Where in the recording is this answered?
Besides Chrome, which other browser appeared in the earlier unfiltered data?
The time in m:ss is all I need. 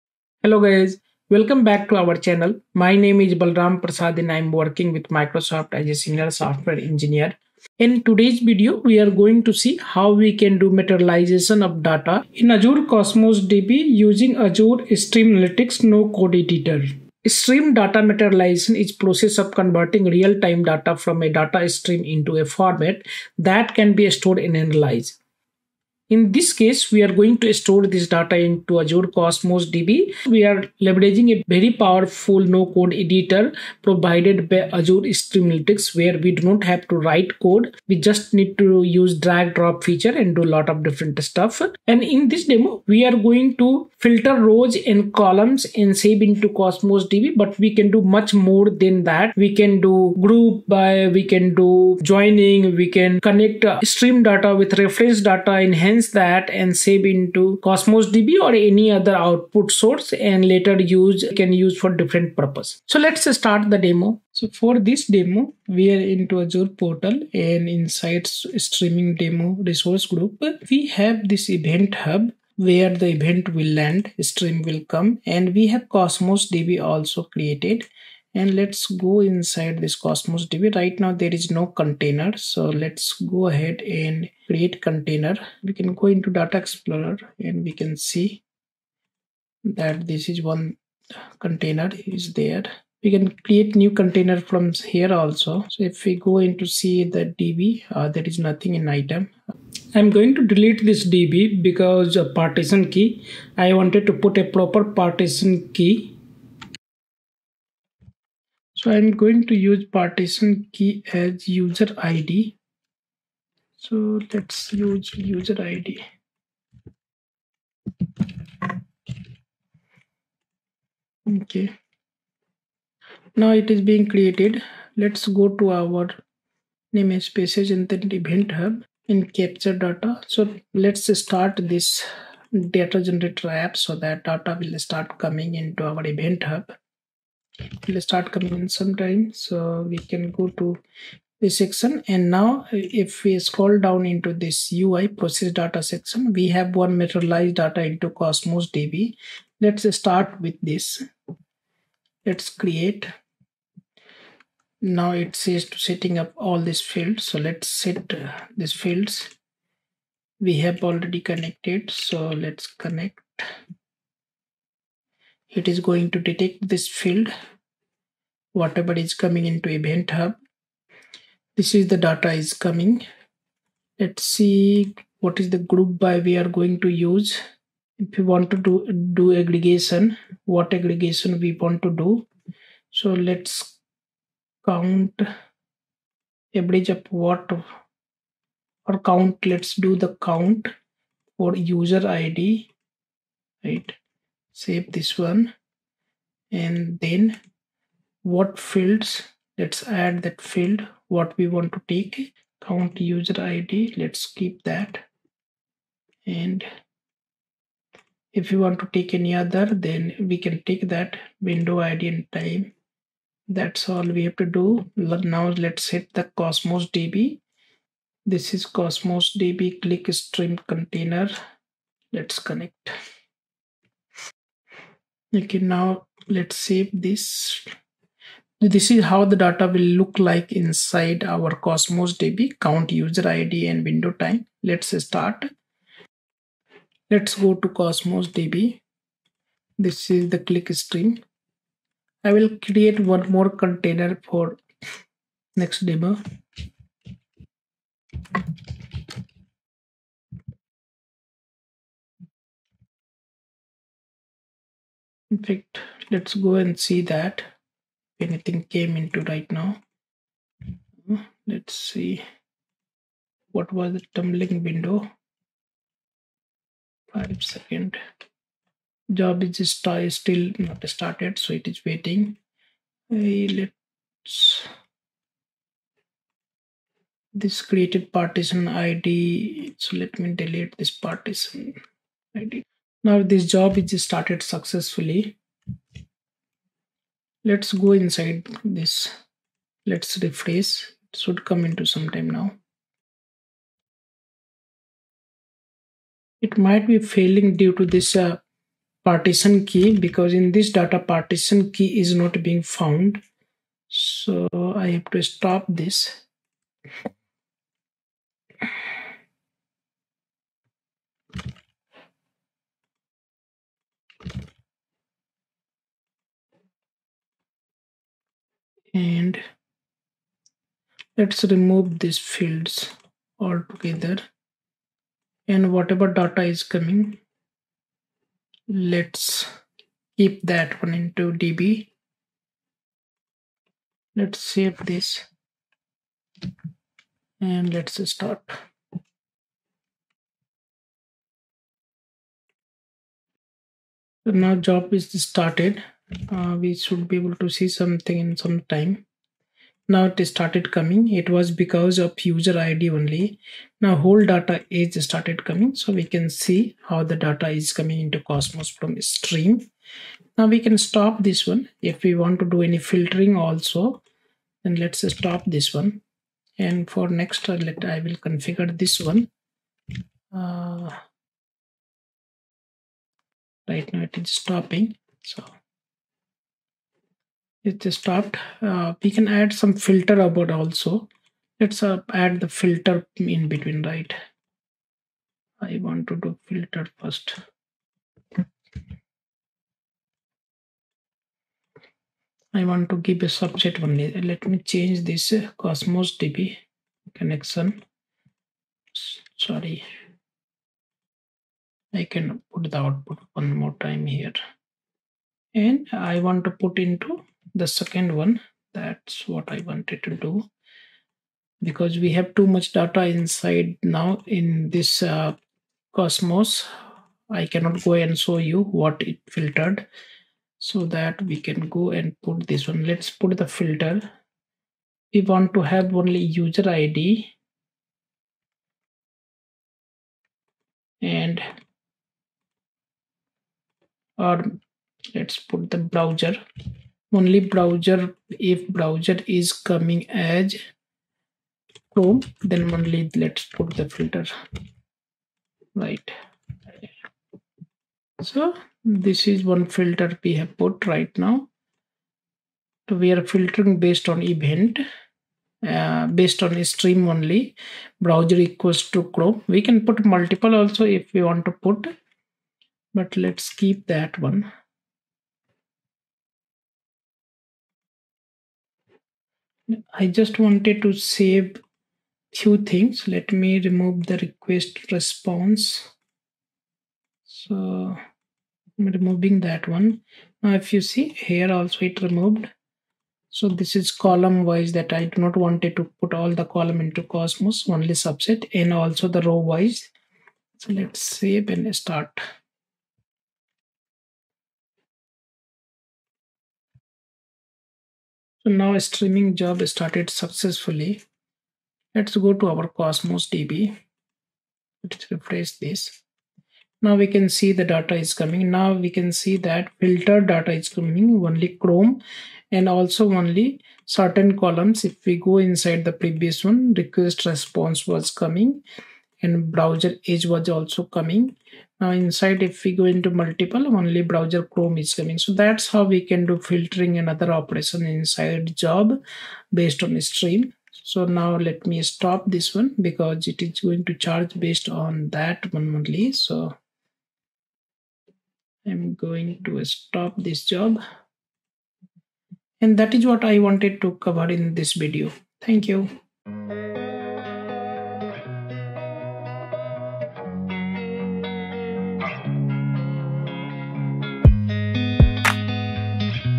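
8:39.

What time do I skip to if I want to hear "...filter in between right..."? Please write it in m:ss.
6:22.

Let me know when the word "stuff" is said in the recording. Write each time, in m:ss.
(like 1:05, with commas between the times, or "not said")
0:41.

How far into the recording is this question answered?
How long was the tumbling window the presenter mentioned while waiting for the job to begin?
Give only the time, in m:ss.
4:27.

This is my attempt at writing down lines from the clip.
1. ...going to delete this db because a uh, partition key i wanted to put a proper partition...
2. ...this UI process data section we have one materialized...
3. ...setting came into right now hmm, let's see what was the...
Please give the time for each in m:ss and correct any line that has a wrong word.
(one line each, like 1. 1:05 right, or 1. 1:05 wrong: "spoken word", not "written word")
1. 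1:40 right
2. 2:24 right
3. 4:18 wrong: "anything", not "setting".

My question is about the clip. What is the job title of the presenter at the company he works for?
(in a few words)
Senior software engineer.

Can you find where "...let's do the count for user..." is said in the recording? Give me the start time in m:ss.
3:09.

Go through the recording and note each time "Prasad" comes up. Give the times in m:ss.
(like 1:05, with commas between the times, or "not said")
0:03.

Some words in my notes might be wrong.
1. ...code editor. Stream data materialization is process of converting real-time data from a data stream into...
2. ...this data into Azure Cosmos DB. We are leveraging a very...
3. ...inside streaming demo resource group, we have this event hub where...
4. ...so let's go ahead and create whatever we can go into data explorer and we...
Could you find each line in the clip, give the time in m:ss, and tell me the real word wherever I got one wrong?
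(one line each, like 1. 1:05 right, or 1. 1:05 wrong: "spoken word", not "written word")
1. 0:16 right
2. 0:27 right
3. 1:07 right
4. 1:22 wrong: "container", not "whatever".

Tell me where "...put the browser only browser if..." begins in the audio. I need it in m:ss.
7:15.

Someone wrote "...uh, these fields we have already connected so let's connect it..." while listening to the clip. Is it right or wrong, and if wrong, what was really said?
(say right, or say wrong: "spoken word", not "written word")
right.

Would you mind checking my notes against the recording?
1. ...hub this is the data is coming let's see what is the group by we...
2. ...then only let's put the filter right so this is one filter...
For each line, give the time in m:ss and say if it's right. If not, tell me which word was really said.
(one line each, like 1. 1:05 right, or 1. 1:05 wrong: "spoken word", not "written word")
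1. 2:50 right
2. 7:22 right.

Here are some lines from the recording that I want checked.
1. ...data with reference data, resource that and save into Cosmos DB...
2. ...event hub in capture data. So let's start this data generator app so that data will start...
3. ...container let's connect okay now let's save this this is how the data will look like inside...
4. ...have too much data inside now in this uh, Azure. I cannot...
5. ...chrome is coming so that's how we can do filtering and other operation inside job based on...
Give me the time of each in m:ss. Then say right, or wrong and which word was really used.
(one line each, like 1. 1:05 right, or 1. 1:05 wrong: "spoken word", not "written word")
1. 0:54 wrong: "enhance", not "resource"
2. 2:08 right
3. 3:40 right
4. 6:52 wrong: "Cosmos", not "Azure"
5. 8:44 right.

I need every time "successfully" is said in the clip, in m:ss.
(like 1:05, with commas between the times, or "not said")
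4:44, 8:20.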